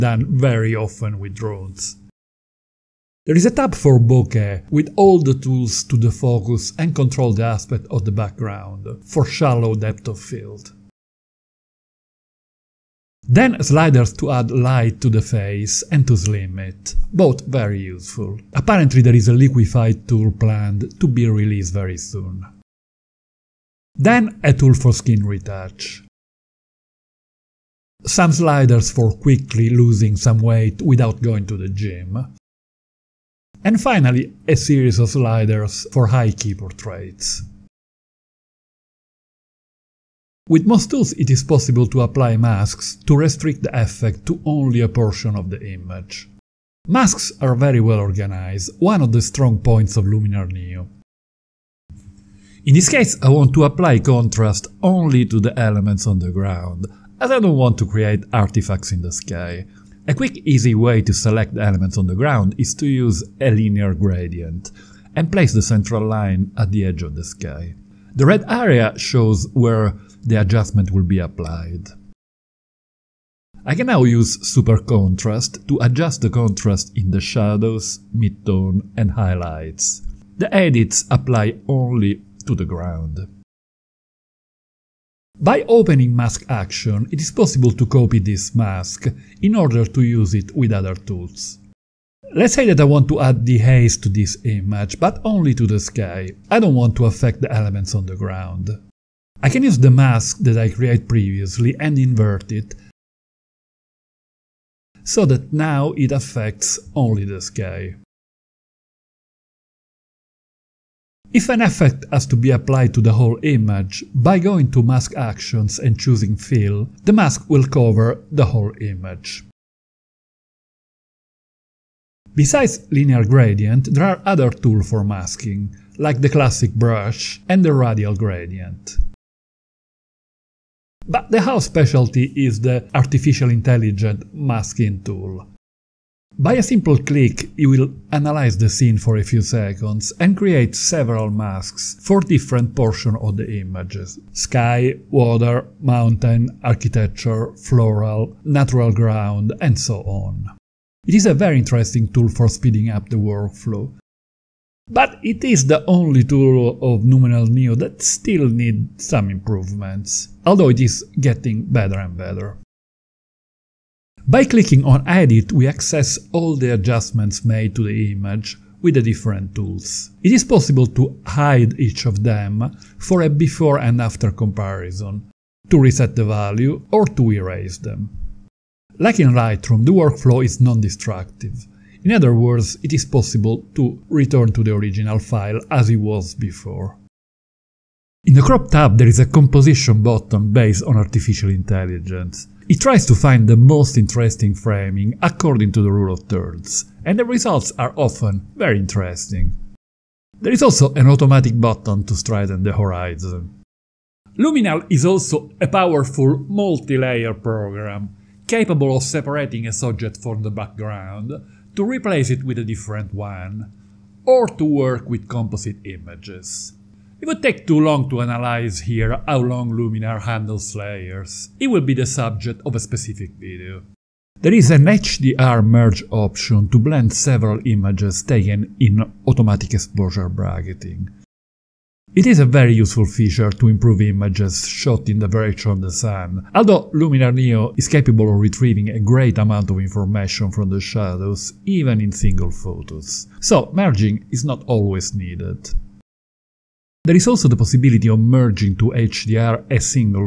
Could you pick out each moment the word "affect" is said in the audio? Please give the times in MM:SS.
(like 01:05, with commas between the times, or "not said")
01:37, 01:46.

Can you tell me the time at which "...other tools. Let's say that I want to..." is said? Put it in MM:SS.
01:30.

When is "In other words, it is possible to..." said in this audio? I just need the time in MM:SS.
03:02.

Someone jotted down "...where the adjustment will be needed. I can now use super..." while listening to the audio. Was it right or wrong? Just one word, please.
wrong.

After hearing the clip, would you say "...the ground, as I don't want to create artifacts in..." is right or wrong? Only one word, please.
right.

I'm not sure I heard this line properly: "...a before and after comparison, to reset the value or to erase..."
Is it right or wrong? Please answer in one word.
right.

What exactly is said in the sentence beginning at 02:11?
But the house specialty is the artificial intelligent masking tool.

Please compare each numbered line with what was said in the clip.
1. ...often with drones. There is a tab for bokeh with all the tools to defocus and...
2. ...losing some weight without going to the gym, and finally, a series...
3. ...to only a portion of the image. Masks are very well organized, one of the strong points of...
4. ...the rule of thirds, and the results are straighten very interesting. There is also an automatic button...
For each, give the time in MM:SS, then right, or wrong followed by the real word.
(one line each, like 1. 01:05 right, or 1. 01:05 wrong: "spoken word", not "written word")
1. 00:00 right
2. 00:29 right
3. 00:44 right
4. 03:15 wrong: "often", not "straighten".